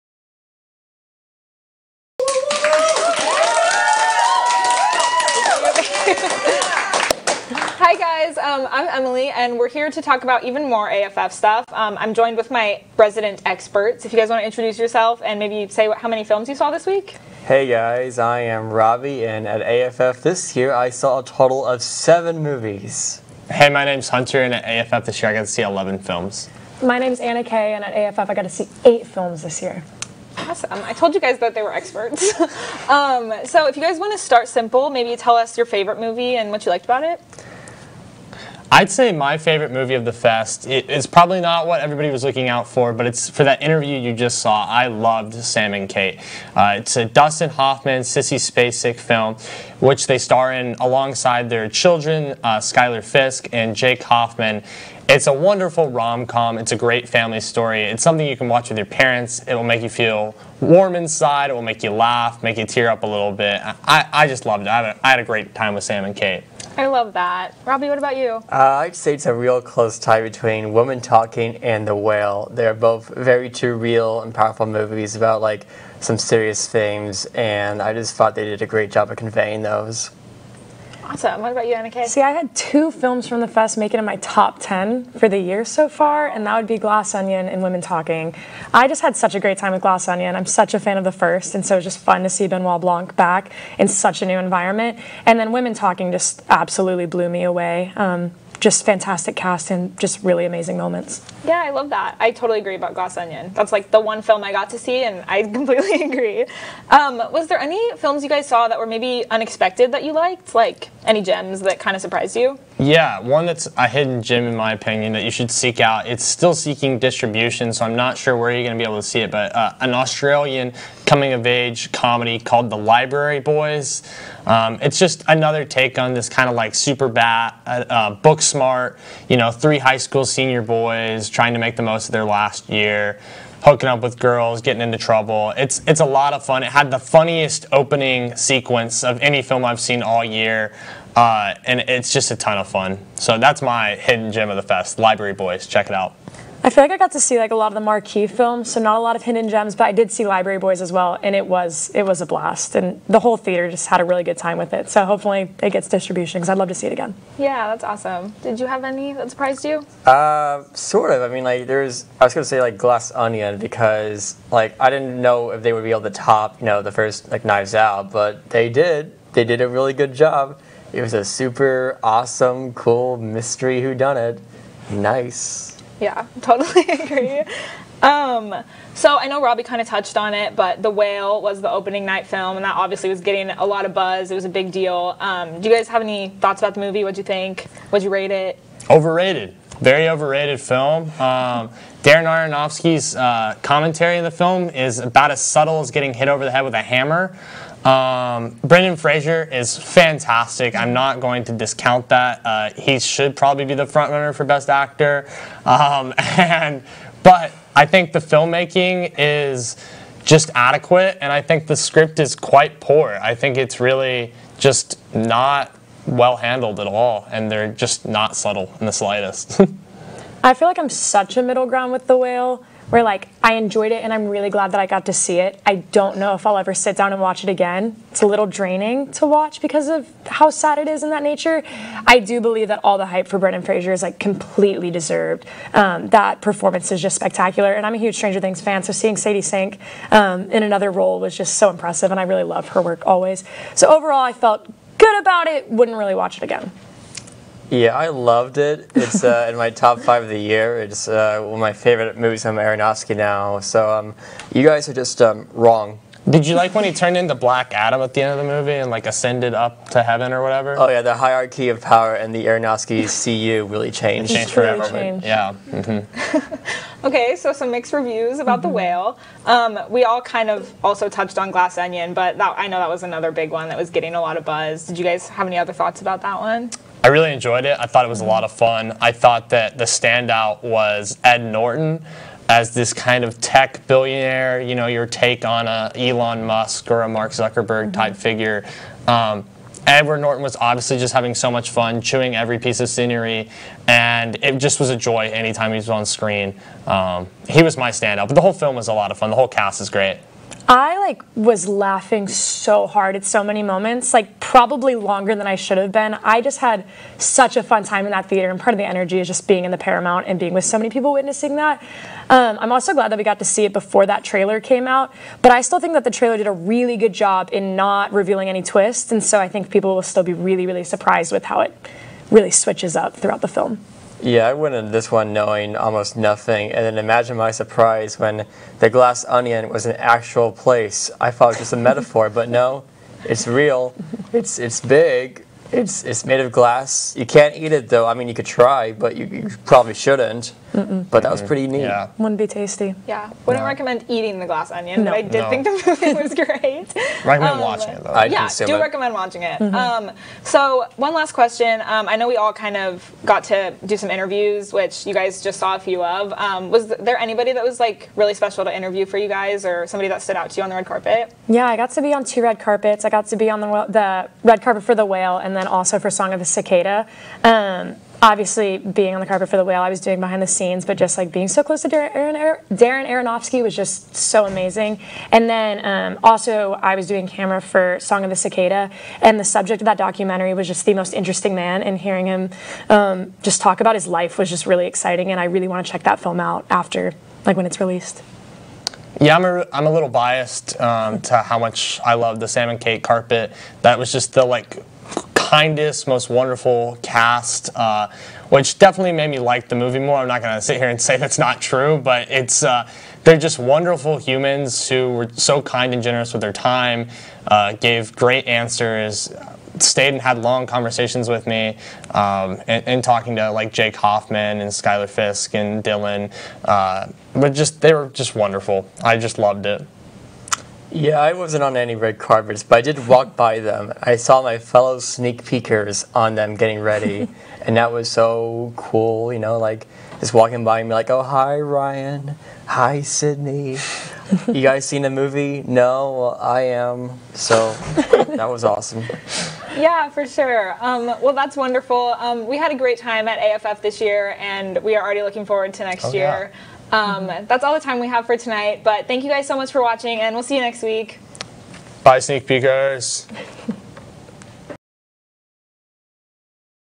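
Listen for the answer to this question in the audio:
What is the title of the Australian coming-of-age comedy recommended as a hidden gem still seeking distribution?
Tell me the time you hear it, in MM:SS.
02:02.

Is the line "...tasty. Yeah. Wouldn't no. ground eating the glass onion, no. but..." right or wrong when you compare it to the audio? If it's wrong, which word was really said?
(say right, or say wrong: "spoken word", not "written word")
wrong: "recommend", not "ground".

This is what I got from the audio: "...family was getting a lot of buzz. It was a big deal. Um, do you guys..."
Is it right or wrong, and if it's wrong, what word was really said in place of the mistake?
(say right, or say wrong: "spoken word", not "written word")
wrong: "obviously", not "family".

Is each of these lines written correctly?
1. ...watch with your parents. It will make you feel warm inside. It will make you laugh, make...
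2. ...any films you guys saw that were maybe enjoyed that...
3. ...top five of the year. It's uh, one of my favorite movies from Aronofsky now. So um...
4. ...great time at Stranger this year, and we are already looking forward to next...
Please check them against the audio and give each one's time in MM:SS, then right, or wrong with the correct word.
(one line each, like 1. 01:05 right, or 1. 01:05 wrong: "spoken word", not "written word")
1. 00:58 right
2. 01:47 wrong: "unexpected", not "enjoyed"
3. 04:09 right
4. 07:22 wrong: "AFF", not "Stranger".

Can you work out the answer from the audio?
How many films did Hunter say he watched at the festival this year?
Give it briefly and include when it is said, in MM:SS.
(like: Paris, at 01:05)
11, at 00:25.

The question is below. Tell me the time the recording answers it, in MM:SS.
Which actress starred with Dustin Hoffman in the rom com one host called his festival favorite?
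00:48.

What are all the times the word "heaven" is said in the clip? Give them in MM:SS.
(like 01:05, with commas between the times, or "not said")
04:20.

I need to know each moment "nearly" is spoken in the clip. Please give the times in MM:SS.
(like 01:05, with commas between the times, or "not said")
not said.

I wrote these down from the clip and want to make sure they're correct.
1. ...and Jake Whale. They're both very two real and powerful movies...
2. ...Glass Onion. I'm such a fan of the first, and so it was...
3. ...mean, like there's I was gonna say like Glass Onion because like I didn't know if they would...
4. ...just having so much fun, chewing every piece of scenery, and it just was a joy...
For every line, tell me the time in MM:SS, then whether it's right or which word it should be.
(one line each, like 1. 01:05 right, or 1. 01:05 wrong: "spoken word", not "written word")
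1. 01:11 wrong: "The", not "Jake"
2. 01:29 right
3. 02:41 right
4. 04:50 right.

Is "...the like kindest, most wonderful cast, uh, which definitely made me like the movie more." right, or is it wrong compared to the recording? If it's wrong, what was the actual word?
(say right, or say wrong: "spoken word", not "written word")
right.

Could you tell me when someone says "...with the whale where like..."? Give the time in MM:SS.
03:41.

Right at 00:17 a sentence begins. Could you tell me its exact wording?
Hey guys, I am Robbie, and at AFF this year, I saw a total of seven movies.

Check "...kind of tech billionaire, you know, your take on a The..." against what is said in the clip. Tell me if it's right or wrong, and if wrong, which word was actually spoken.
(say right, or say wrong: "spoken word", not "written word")
wrong: "Elon", not "The".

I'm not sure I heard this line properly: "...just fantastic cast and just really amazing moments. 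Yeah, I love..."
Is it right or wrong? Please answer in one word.
right.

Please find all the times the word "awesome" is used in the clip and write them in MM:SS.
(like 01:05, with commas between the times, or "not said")
00:30, 01:21, 02:37, 02:52, 07:18.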